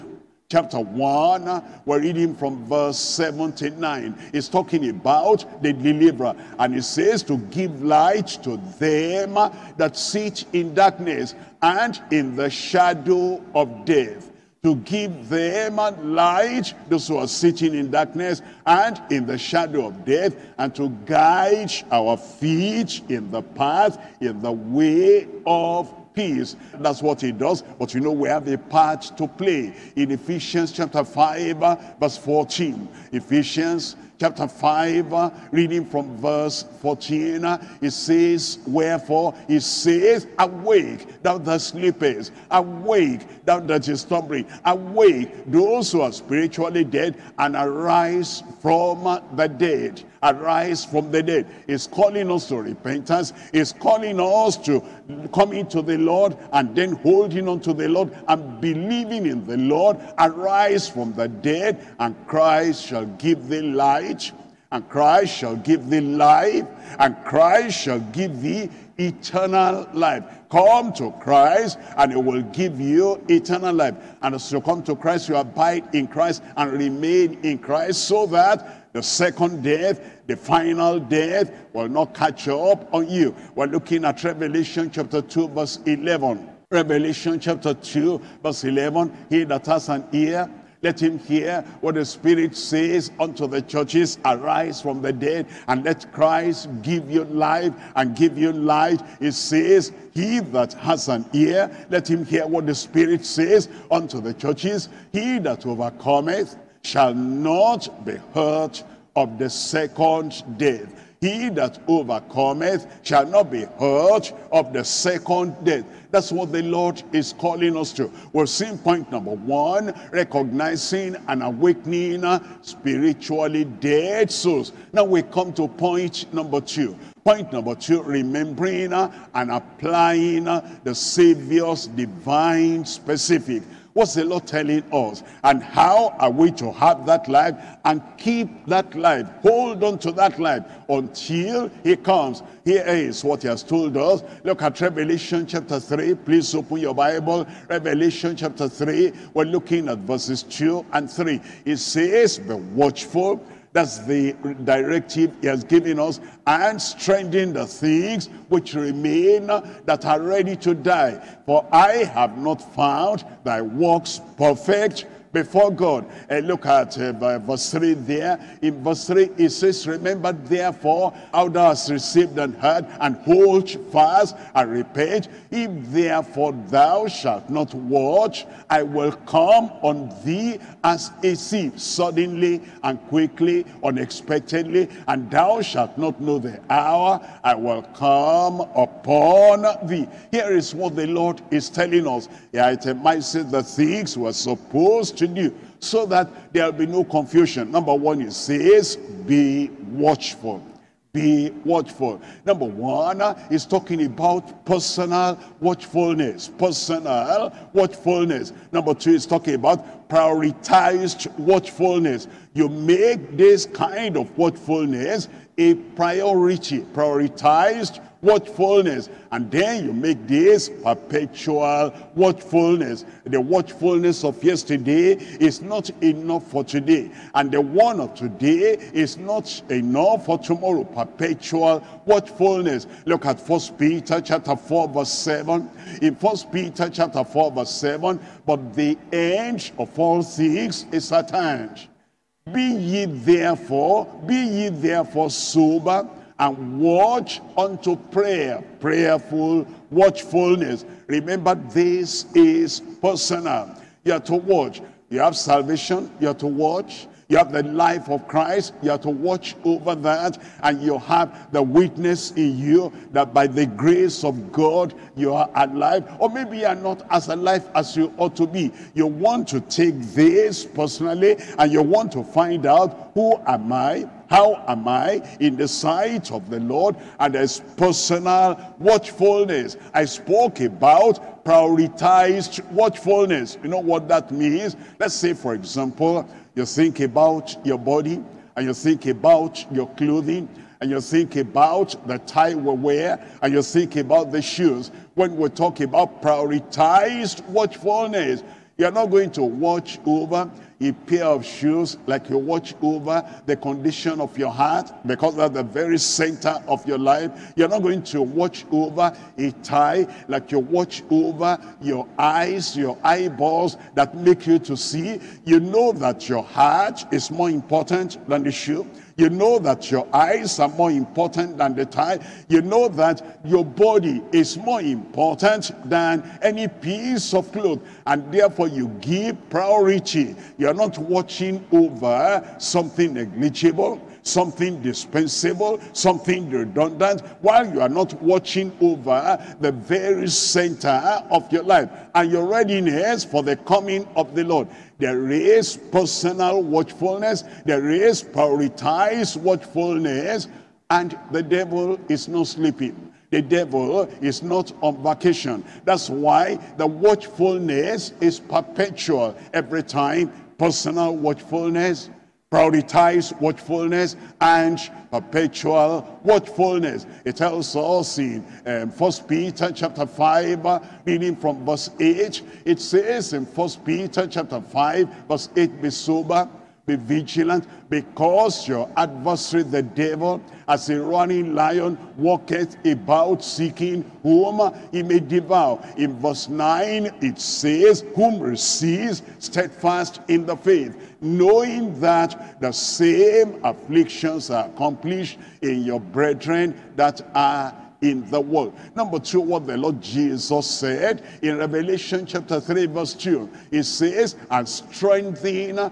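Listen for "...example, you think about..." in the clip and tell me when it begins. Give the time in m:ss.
4:45.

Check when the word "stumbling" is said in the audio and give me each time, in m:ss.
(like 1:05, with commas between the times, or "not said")
0:43.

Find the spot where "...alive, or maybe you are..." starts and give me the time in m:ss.
4:25.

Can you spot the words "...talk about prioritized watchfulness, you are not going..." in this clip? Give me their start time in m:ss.
4:55.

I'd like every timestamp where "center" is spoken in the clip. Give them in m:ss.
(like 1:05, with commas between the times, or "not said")
5:05, 5:40.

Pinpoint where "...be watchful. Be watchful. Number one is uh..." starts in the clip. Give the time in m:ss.
3:18.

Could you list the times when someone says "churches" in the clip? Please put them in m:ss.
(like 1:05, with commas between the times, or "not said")
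1:33, 1:44.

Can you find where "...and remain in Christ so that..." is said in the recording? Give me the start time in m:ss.
1:16.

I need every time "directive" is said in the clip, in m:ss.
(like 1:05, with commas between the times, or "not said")
2:34.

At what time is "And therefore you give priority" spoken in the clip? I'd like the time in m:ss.
5:28.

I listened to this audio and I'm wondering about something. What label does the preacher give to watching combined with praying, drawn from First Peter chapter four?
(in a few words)
Prayerful watchfulness.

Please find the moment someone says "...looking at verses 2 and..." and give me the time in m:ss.
2:29.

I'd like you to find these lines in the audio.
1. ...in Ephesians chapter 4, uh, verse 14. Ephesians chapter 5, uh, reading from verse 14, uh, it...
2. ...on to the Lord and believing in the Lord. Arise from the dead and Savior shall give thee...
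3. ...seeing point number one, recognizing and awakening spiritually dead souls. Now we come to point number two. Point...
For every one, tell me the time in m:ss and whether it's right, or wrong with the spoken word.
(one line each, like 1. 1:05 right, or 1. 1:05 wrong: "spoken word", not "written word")
1. 0:29 wrong: "5", not "4"
2. 0:57 wrong: "Christ", not "Savior"
3. 1:58 right.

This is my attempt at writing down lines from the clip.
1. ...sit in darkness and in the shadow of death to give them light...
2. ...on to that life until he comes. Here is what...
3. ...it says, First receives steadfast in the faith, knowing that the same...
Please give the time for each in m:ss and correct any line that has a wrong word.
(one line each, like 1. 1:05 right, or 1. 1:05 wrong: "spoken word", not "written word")
1. 0:09 right
2. 2:19 right
3. 6:27 wrong: "Whom", not "First".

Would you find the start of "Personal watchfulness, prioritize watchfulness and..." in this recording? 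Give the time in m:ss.
6:00.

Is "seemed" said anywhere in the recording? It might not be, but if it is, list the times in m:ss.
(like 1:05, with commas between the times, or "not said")
not said.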